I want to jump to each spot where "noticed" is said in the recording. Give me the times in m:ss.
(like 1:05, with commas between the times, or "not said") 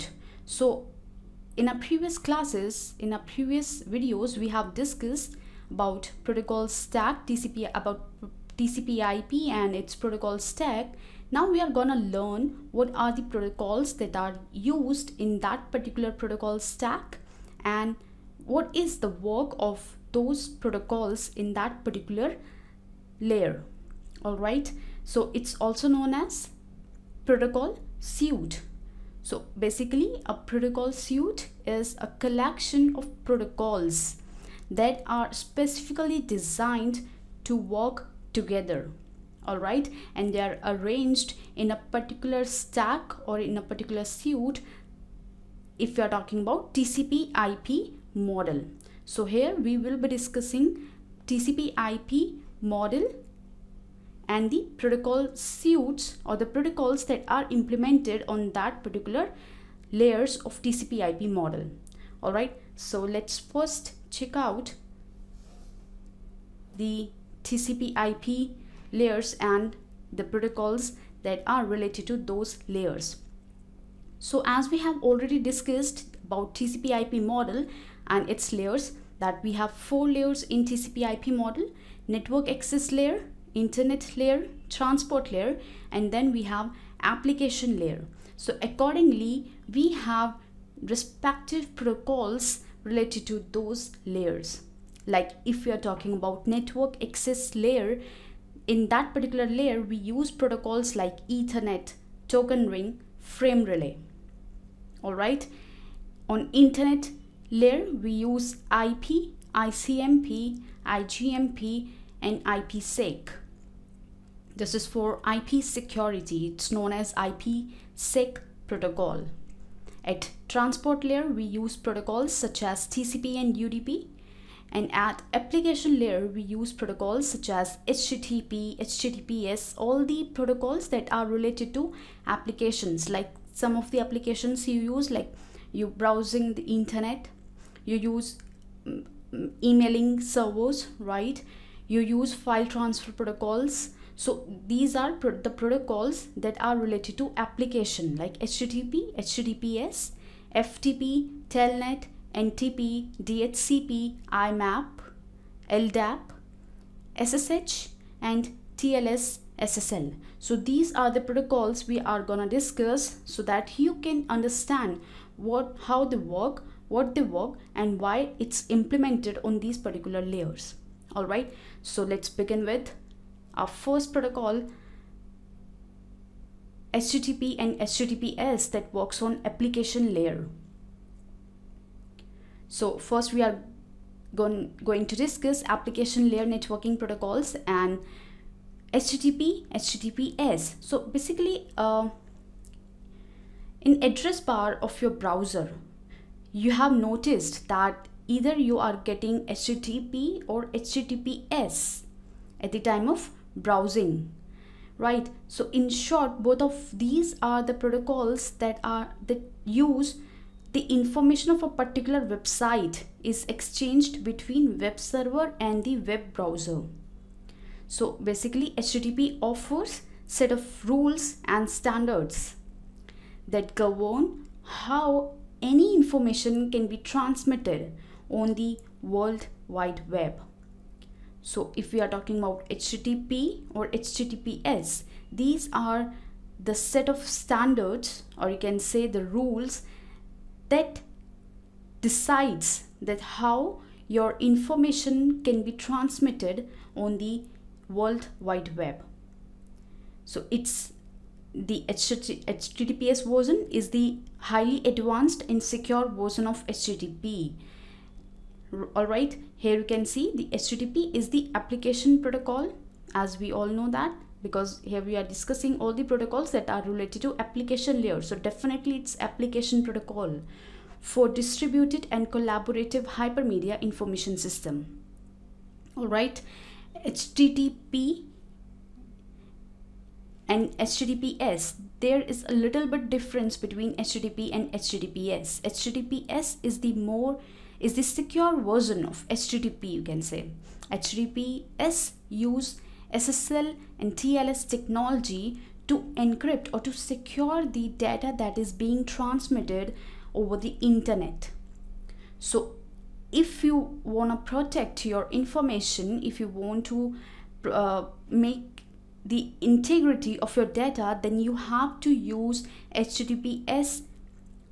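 3:16.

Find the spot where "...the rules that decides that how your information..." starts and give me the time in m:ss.
3:59.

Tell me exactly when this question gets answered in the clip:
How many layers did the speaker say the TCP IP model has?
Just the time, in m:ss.
1:19.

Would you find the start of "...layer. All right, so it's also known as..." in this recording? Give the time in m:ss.
0:23.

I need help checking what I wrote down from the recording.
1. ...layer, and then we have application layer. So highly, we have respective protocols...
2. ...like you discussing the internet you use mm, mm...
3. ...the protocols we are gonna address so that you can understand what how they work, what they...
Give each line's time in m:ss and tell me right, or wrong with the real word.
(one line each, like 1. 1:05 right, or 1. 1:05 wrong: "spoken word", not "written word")
1. 1:25 wrong: "accordingly", not "highly"
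2. 2:15 wrong: "browsing", not "discussing"
3. 2:41 wrong: "discuss", not "address".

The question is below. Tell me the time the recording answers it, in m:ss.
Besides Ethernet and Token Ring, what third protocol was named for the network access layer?
1:43.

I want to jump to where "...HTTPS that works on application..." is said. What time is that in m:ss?
2:57.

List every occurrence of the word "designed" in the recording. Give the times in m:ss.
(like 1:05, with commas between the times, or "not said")
0:36.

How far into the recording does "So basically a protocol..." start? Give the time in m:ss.
0:29.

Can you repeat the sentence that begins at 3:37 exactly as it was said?
So basically HTTP offers set of rules and standards that govern how any information can be transmitted on the World Wide Web.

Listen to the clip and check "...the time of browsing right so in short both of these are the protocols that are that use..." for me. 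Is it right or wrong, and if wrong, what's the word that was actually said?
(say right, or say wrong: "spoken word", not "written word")
right.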